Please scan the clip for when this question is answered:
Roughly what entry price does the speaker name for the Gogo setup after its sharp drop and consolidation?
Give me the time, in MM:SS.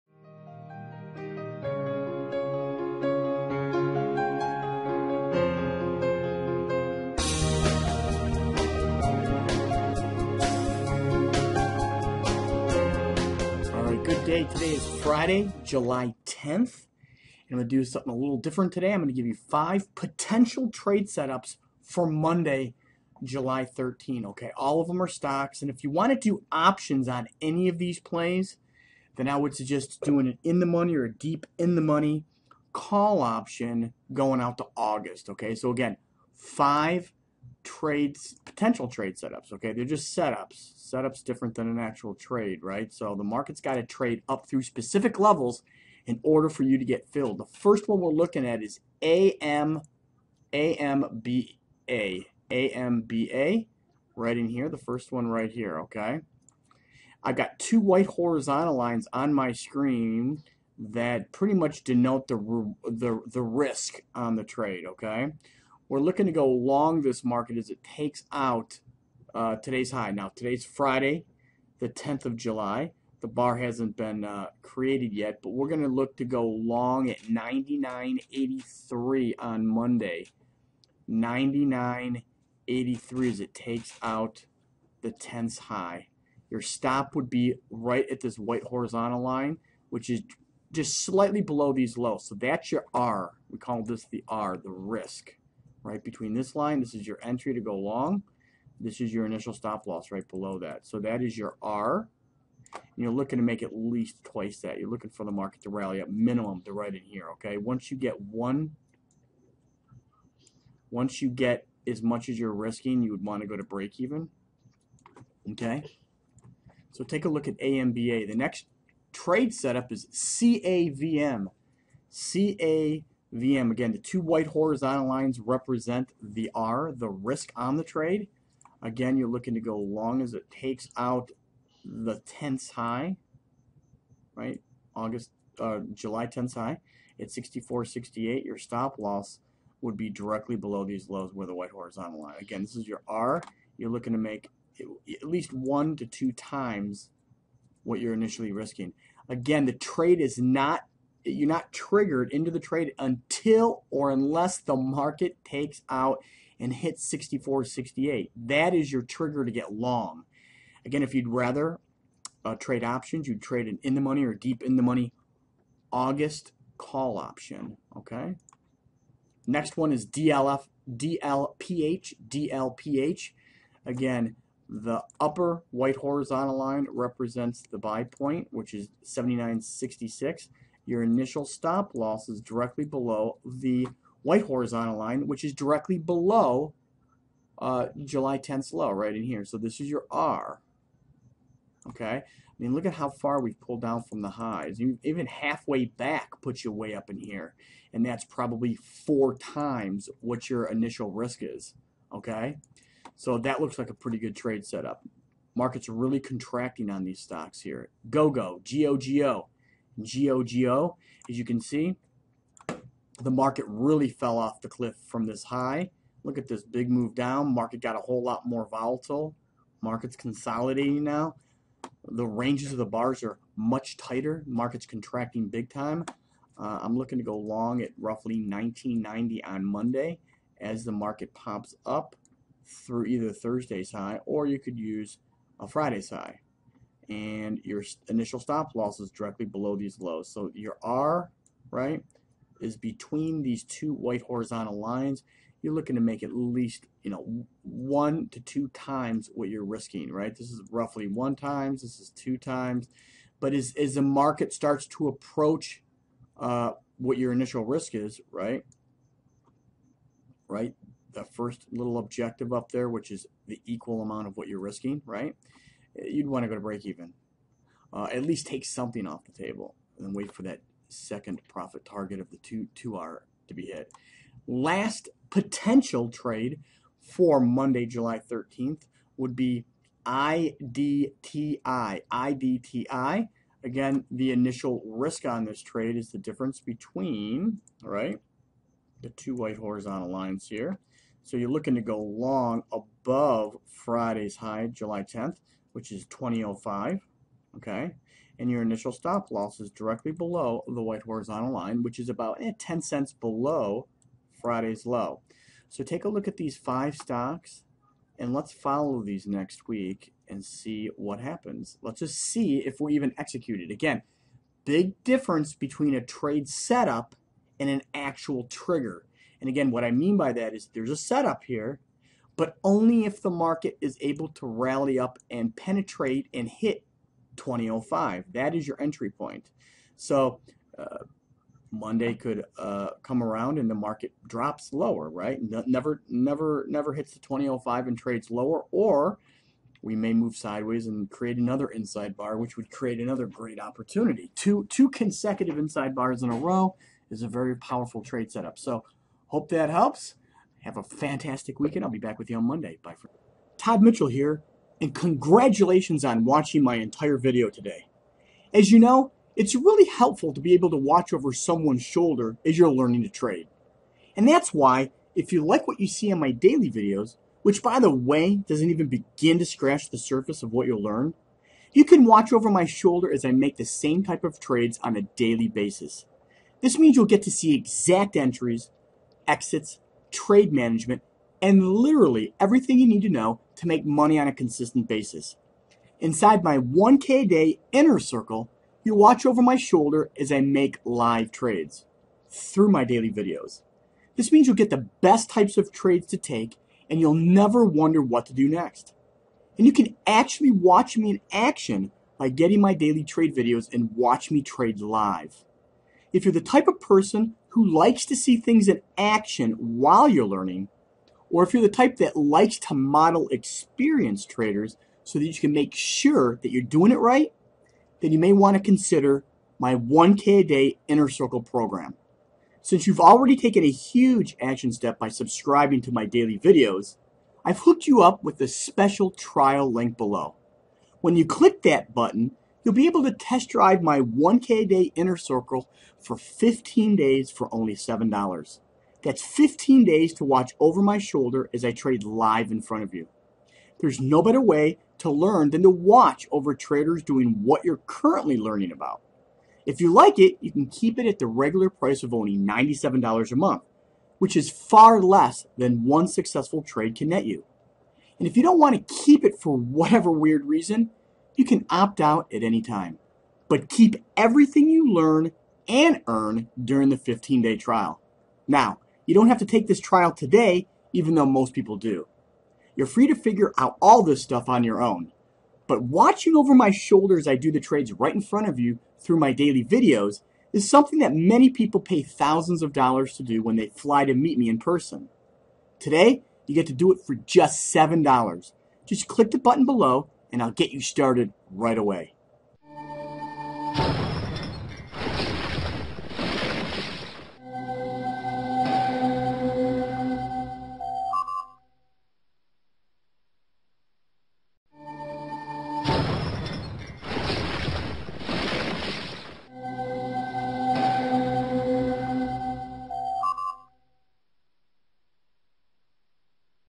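03:47.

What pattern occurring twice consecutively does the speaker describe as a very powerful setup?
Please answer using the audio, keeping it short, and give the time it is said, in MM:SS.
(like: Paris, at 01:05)
inside bars, at 05:45.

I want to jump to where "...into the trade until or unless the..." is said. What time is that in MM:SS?
02:32.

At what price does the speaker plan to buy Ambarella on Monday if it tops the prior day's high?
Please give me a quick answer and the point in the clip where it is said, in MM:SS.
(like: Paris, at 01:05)
99.83, at 01:21.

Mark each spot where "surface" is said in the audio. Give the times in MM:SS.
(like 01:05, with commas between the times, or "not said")
06:09.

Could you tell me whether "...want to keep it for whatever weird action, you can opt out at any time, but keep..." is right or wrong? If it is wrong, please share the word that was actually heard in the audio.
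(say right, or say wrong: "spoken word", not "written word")
wrong: "reason", not "action".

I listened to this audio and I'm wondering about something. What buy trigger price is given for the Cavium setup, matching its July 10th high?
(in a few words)
64.68.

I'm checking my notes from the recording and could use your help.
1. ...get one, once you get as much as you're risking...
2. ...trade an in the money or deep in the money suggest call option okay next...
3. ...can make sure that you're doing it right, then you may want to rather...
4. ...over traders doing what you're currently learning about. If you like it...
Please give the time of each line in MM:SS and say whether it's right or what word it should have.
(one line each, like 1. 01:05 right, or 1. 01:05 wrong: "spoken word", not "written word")
1. 01:47 right
2. 02:43 wrong: "august", not "suggest"
3. 06:55 wrong: "consider", not "rather"
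4. 07:26 right.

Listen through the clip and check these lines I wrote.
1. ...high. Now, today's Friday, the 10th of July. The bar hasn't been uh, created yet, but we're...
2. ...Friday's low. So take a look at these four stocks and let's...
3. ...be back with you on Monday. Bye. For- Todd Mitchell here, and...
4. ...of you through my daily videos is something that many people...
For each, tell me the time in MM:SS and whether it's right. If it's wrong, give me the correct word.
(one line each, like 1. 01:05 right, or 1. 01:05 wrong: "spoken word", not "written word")
1. 01:09 right
2. 05:04 wrong: "five", not "four"
3. 05:51 right
4. 07:58 right.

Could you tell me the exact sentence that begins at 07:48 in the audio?
Now, you don't have to take this trial today, even though most people do.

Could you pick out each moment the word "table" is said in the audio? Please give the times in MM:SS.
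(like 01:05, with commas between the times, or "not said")
04:29.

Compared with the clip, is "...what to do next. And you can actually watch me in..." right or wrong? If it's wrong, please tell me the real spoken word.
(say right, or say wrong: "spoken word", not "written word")
right.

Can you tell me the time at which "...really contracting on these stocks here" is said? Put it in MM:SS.
03:25.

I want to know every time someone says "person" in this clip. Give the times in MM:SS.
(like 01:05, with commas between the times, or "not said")
06:46, 08:04.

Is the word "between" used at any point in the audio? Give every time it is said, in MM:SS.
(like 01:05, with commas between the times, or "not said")
01:36, 04:02, 04:46, 05:15.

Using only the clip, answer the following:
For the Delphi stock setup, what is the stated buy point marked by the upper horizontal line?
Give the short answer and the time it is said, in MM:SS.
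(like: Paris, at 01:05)
79.66, at 02:58.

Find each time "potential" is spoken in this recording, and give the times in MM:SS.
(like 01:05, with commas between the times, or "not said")
00:19, 00:38, 04:35.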